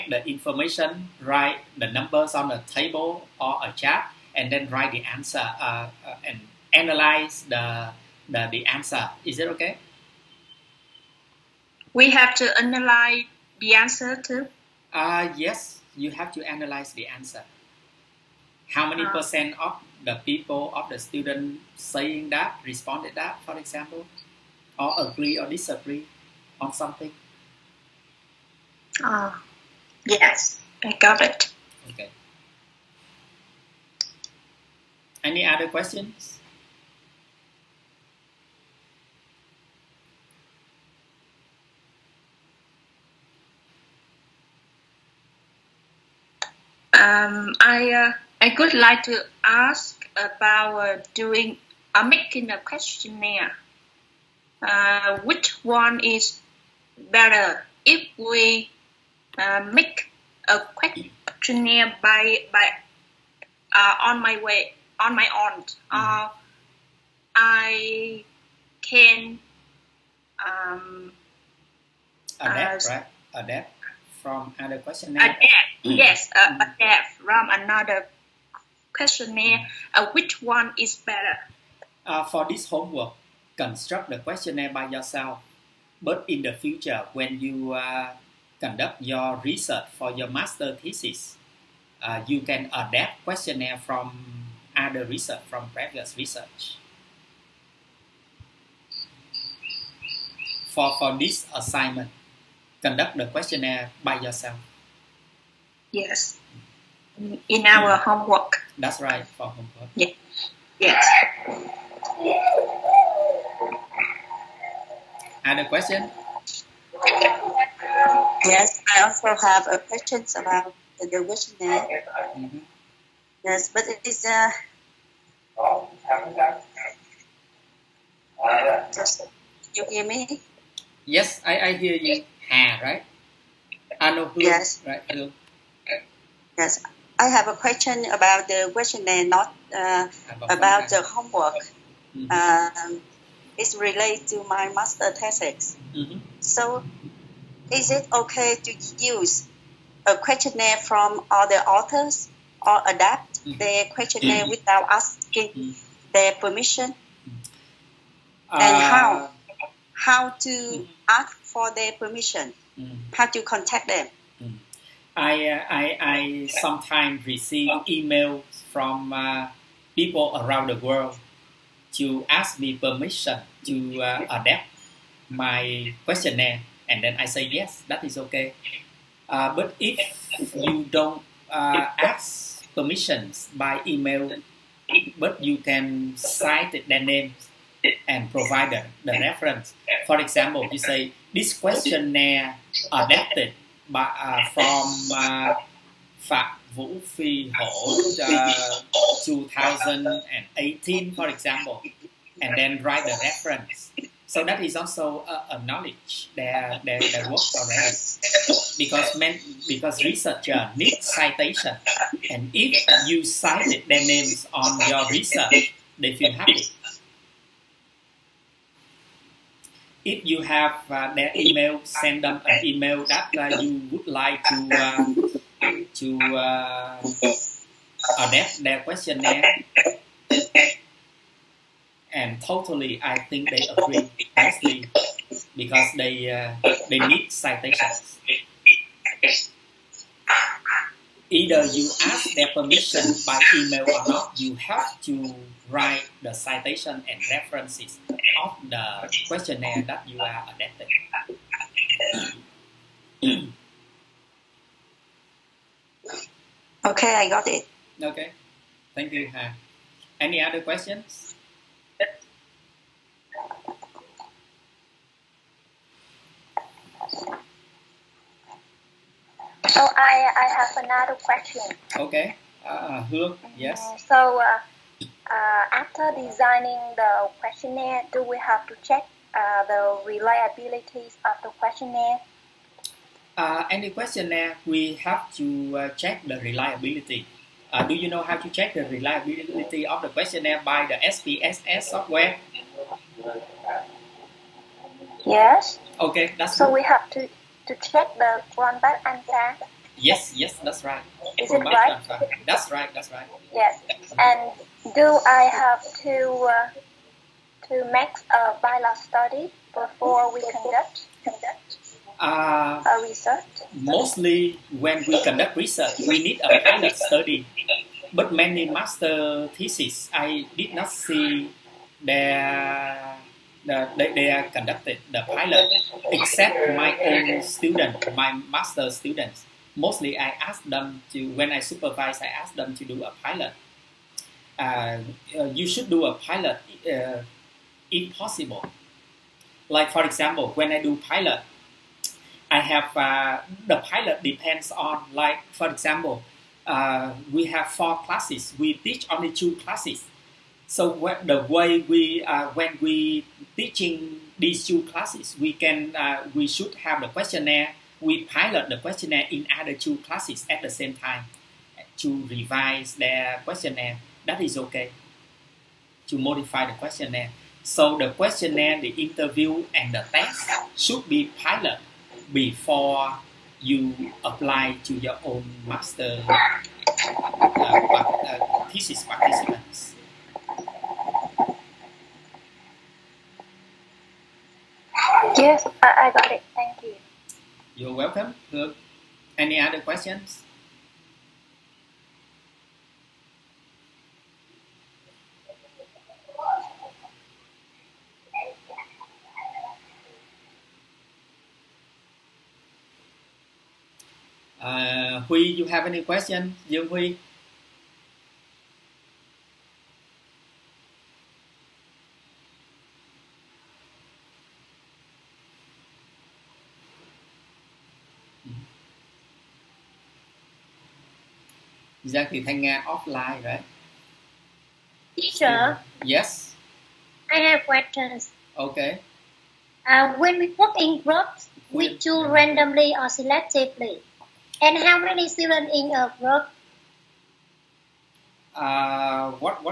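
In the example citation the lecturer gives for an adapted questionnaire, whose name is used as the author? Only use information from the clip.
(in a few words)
Phạm Vũ Phi Hổ.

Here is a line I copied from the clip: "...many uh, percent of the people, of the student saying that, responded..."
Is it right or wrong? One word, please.
right.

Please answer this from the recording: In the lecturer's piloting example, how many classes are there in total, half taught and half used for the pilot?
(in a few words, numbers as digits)
4.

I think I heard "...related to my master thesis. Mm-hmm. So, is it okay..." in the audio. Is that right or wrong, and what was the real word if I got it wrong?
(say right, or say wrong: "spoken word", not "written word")
right.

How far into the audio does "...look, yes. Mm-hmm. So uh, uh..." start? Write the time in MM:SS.
04:33.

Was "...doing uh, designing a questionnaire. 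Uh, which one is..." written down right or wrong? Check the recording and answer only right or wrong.
wrong.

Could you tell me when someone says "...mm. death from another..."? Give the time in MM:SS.
01:16.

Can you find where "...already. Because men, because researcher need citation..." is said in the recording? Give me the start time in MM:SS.
03:27.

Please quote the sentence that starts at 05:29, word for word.
Mostly I ask them to, when I supervise, I ask them to do a pilot.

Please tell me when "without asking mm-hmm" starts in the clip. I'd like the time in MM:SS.
02:34.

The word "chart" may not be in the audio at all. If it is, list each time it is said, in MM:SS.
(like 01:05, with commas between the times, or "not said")
00:03.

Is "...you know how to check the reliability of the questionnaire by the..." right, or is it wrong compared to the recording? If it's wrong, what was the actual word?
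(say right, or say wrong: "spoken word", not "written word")
right.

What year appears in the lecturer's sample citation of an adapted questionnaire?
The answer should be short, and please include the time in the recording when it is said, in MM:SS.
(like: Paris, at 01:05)
2018, at 03:19.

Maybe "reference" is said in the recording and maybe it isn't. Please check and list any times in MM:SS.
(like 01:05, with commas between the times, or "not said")
03:09, 03:23, 04:07.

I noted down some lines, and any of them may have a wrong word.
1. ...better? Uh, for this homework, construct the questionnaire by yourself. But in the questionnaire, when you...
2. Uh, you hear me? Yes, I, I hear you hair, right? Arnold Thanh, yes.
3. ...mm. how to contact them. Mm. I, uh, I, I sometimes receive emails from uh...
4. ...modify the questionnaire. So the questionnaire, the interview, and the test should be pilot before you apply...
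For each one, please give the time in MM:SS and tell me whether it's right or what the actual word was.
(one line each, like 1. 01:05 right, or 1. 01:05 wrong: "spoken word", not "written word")
1. 01:20 wrong: "future", not "questionnaire"
2. 02:05 wrong: "Bloom", not "Thanh"
3. 02:42 right
4. 06:06 right.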